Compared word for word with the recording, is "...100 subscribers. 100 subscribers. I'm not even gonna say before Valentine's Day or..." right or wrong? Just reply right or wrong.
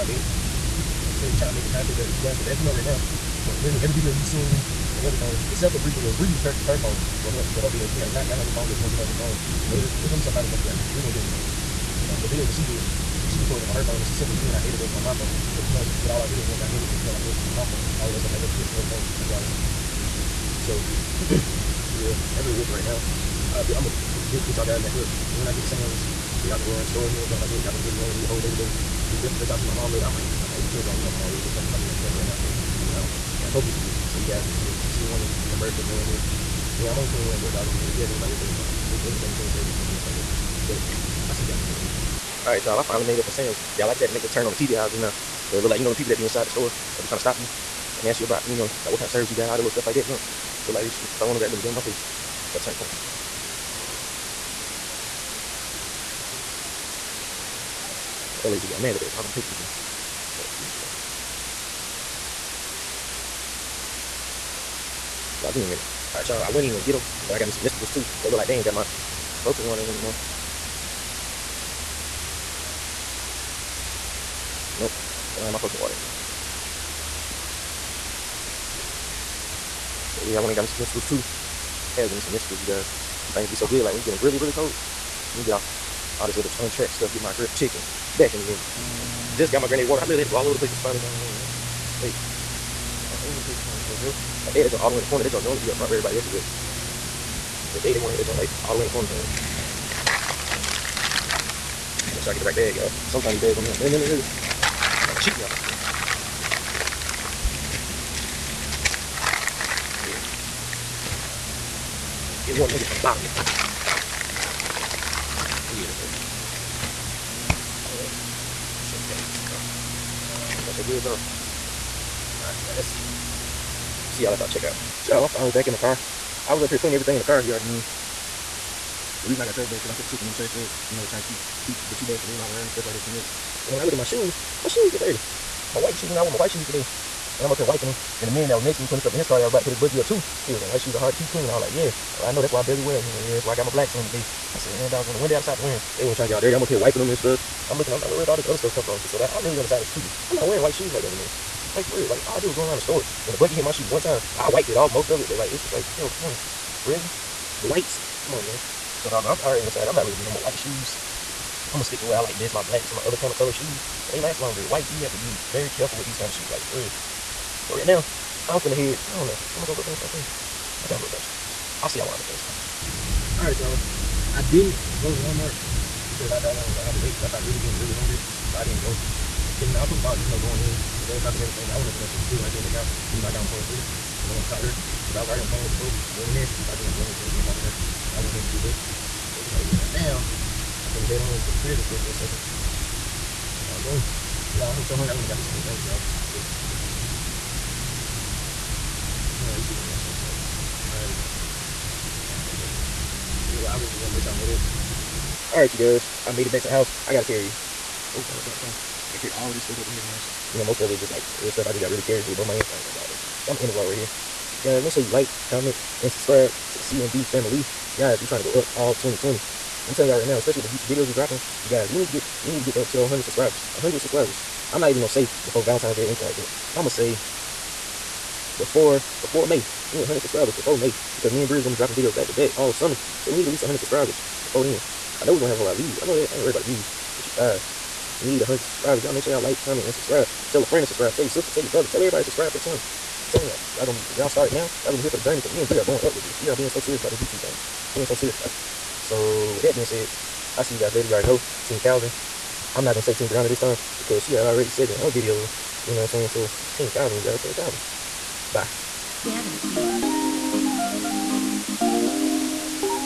right.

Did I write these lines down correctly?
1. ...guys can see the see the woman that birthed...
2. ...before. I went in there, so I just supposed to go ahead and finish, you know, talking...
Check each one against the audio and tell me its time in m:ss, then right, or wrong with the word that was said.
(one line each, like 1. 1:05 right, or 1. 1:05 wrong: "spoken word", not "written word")
1. 0:34 right
2. 3:05 wrong: "wanted", not "supposed".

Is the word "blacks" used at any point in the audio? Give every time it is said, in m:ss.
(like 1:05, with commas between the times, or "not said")
2:23, 2:42.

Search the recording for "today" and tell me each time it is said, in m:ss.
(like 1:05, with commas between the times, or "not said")
0:28, 2:16, 2:24.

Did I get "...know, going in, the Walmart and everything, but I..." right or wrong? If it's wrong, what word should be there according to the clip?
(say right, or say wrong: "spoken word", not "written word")
wrong: "GameStop", not "Walmart".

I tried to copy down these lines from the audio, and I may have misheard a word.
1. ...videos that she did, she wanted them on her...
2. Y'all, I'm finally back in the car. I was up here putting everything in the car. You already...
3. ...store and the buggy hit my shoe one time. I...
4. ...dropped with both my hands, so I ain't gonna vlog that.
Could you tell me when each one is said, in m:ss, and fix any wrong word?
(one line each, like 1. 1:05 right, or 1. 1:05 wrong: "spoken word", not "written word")
1. 0:12 wrong: "recorded", not "wanted"
2. 2:05 right
3. 2:32 right
4. 3:32 wrong: "carried", not "dropped".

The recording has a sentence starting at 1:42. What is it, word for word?
Make sure I get the right bag, y'all.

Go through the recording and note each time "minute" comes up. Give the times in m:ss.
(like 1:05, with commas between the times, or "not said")
0:41, 1:05, 1:28.